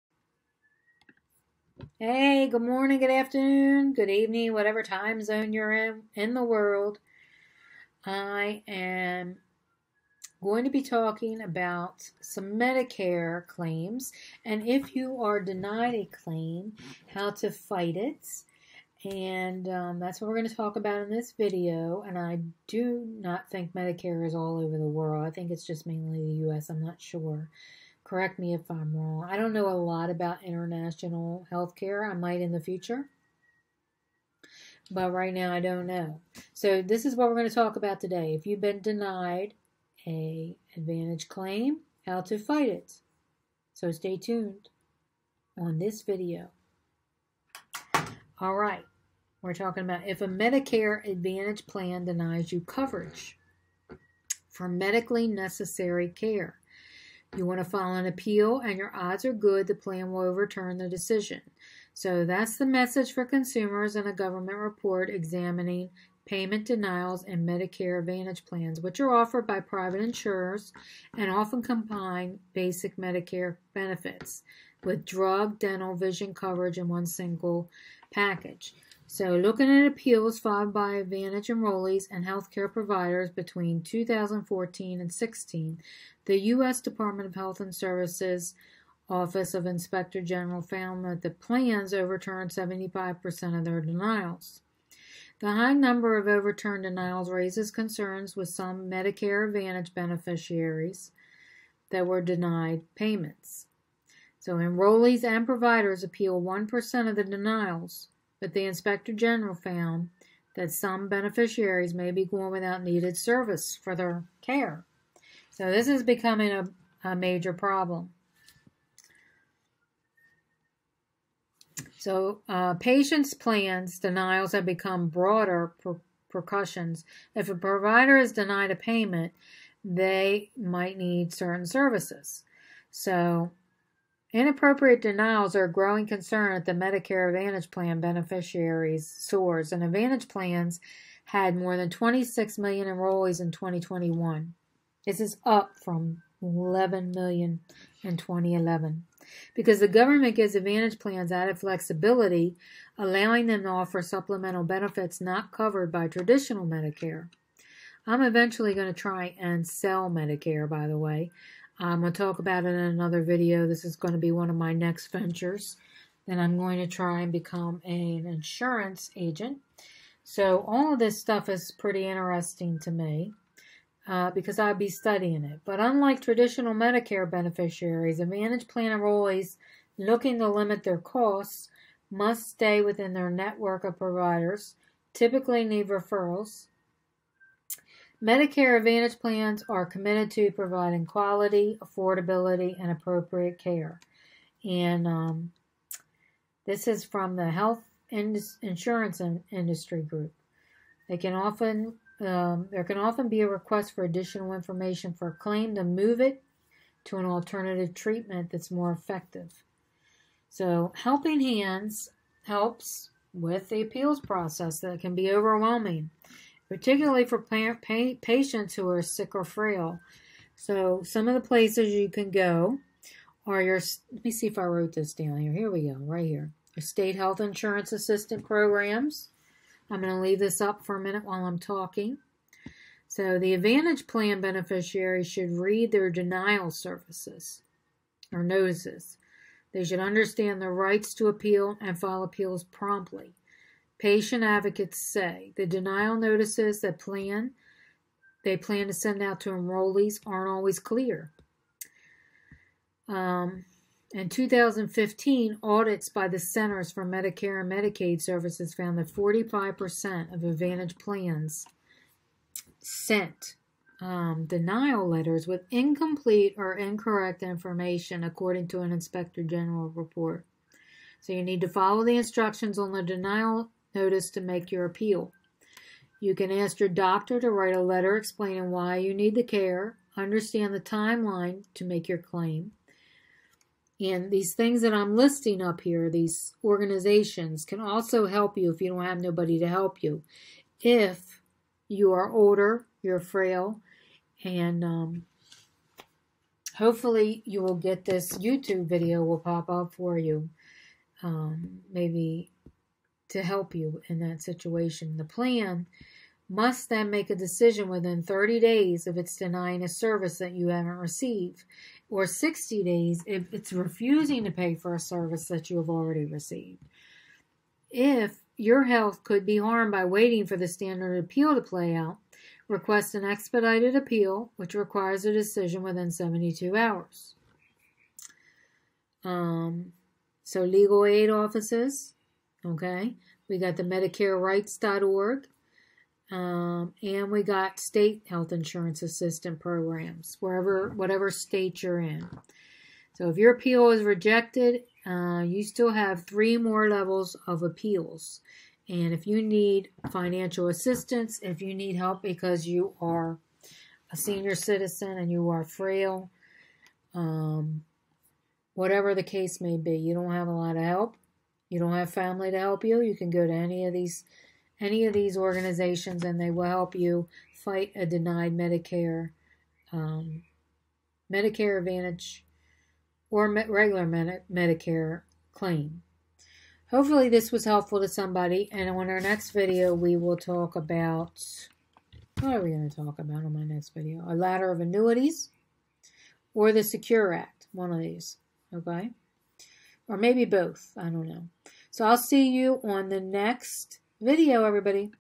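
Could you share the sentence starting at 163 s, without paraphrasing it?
This is going to be one of my next ventures.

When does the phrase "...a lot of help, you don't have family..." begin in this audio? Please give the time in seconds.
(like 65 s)
360 s.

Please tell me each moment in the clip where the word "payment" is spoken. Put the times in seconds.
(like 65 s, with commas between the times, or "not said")
66 s, 102 s, 128 s.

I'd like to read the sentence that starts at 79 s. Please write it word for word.
So, looking at appeals filed by Advantage enrollees and healthcare providers between 2014 and 16, the U.S.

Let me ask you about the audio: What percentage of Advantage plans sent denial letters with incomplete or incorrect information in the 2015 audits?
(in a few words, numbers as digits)
45%.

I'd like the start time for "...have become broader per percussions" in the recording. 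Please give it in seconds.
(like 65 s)
124 s.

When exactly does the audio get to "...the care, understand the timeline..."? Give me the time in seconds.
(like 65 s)
279 s.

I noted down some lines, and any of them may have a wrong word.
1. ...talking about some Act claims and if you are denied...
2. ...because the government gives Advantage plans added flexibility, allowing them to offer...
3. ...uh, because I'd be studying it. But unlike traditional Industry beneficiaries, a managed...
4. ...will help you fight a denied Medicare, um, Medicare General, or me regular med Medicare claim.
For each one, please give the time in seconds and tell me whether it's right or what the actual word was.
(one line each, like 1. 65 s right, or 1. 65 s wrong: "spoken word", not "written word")
1. 10 s wrong: "Medicare", not "Act"
2. 149 s right
3. 174 s wrong: "Medicare", not "Industry"
4. 366 s wrong: "Advantage", not "General".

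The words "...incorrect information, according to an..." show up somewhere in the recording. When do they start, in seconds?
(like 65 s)
266 s.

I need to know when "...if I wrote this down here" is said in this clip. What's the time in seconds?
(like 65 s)
224 s.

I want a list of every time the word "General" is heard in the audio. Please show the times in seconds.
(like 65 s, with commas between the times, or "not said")
90 s, 109 s, 269 s.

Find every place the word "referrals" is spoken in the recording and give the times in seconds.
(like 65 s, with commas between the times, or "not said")
185 s.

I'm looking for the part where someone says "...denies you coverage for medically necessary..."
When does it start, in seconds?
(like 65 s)
52 s.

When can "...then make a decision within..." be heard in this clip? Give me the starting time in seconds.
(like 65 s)
306 s.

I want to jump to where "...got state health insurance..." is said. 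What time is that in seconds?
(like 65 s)
337 s.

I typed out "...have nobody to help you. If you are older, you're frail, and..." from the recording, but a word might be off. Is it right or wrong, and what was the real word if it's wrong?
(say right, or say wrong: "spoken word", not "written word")
right.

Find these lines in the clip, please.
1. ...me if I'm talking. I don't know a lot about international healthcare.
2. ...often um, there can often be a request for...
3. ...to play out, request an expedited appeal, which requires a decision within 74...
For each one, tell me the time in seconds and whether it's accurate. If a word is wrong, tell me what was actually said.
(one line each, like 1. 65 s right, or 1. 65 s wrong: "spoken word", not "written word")
1. 28 s wrong: "wrong", not "talking"
2. 201 s right
3. 321 s wrong: "72", not "74".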